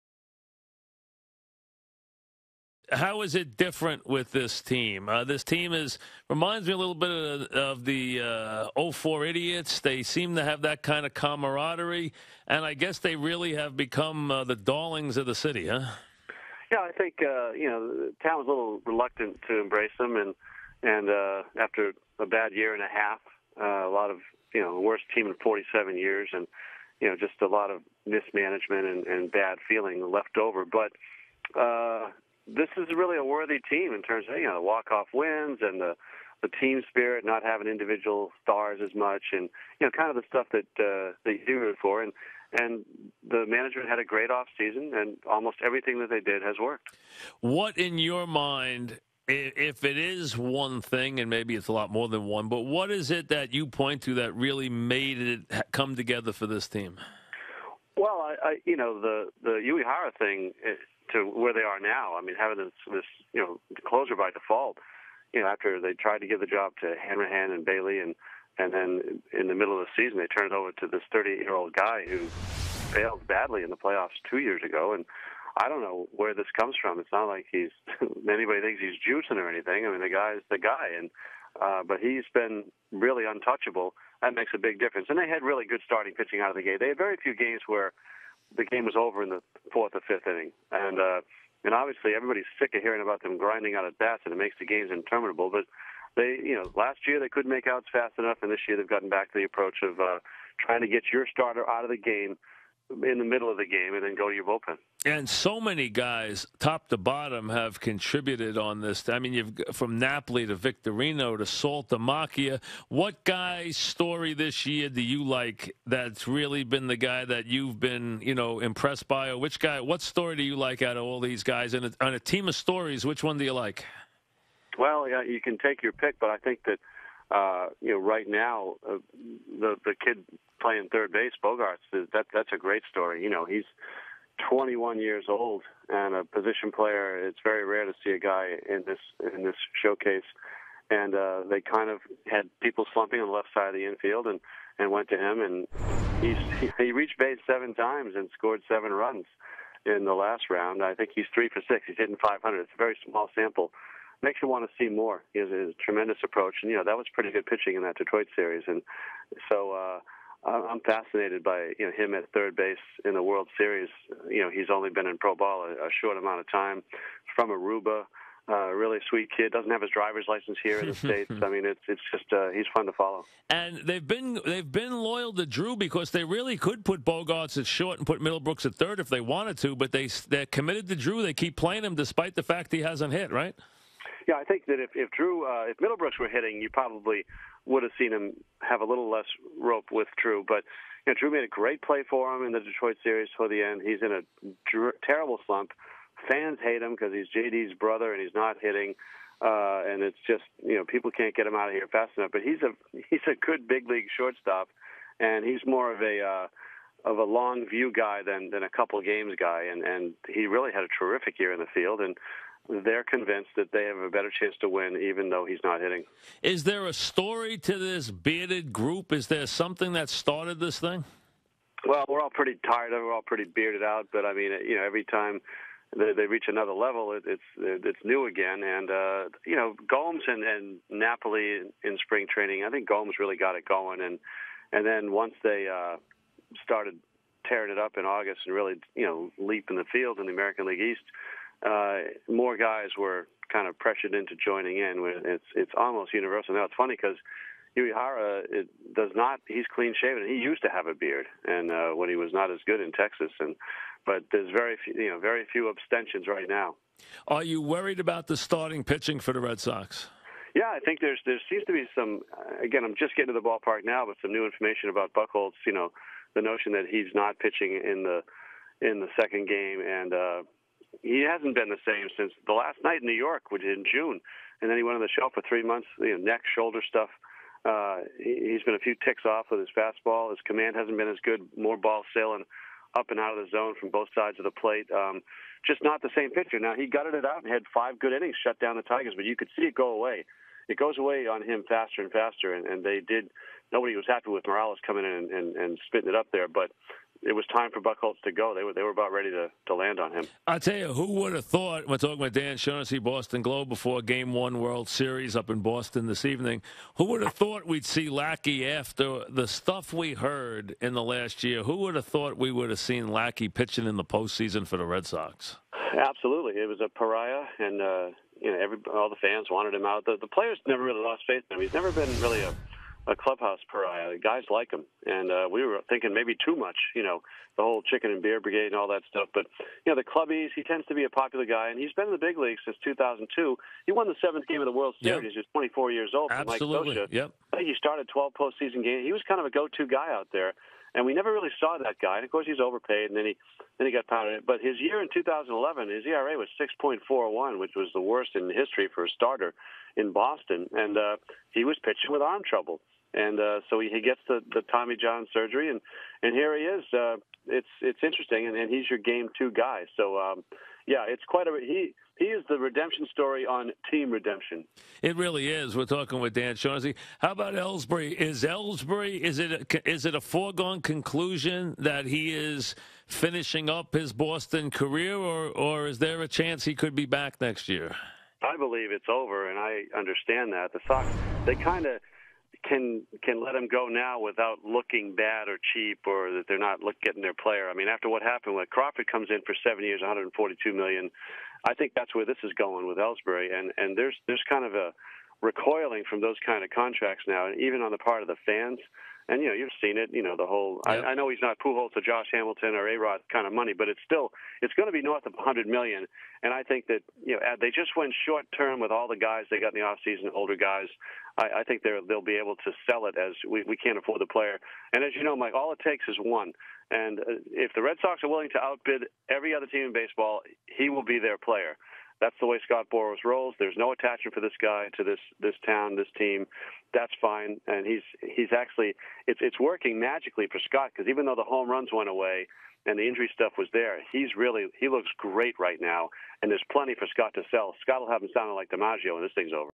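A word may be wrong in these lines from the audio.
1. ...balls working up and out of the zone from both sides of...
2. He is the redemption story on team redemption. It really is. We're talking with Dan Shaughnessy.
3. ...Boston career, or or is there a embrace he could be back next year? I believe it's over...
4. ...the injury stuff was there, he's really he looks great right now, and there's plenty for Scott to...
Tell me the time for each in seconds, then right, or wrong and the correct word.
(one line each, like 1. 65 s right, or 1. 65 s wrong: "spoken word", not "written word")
1. 281 s wrong: "sailing", not "working"
2. 362 s right
3. 374 s wrong: "chance", not "embrace"
4. 432 s right.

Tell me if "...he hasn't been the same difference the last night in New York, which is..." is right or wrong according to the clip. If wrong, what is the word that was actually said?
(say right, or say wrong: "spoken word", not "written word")
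wrong: "since", not "difference".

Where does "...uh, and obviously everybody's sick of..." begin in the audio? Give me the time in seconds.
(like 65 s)
90 s.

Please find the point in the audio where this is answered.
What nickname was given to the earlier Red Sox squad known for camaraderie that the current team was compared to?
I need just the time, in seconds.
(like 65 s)
8 s.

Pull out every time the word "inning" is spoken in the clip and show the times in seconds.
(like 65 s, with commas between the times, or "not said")
90 s, 288 s.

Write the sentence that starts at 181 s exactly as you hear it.
They keep playing him despite the fact he hasn't hit right.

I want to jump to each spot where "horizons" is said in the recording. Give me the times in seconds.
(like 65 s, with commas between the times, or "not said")
not said.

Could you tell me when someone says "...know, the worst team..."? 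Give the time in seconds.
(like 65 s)
24 s.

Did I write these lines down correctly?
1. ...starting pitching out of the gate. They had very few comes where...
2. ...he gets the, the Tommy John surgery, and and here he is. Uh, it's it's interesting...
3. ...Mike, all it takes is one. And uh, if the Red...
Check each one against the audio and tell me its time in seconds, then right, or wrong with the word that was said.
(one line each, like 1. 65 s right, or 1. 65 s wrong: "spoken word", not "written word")
1. 85 s wrong: "games", not "comes"
2. 353 s right
3. 415 s right.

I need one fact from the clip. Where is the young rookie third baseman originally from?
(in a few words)
Aruba.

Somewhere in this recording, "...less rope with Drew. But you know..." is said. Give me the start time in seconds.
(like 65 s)
189 s.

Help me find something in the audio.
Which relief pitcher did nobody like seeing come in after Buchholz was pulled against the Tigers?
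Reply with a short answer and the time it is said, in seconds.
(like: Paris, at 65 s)
Morales, at 294 s.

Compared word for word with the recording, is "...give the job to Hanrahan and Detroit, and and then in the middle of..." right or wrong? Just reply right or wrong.
wrong.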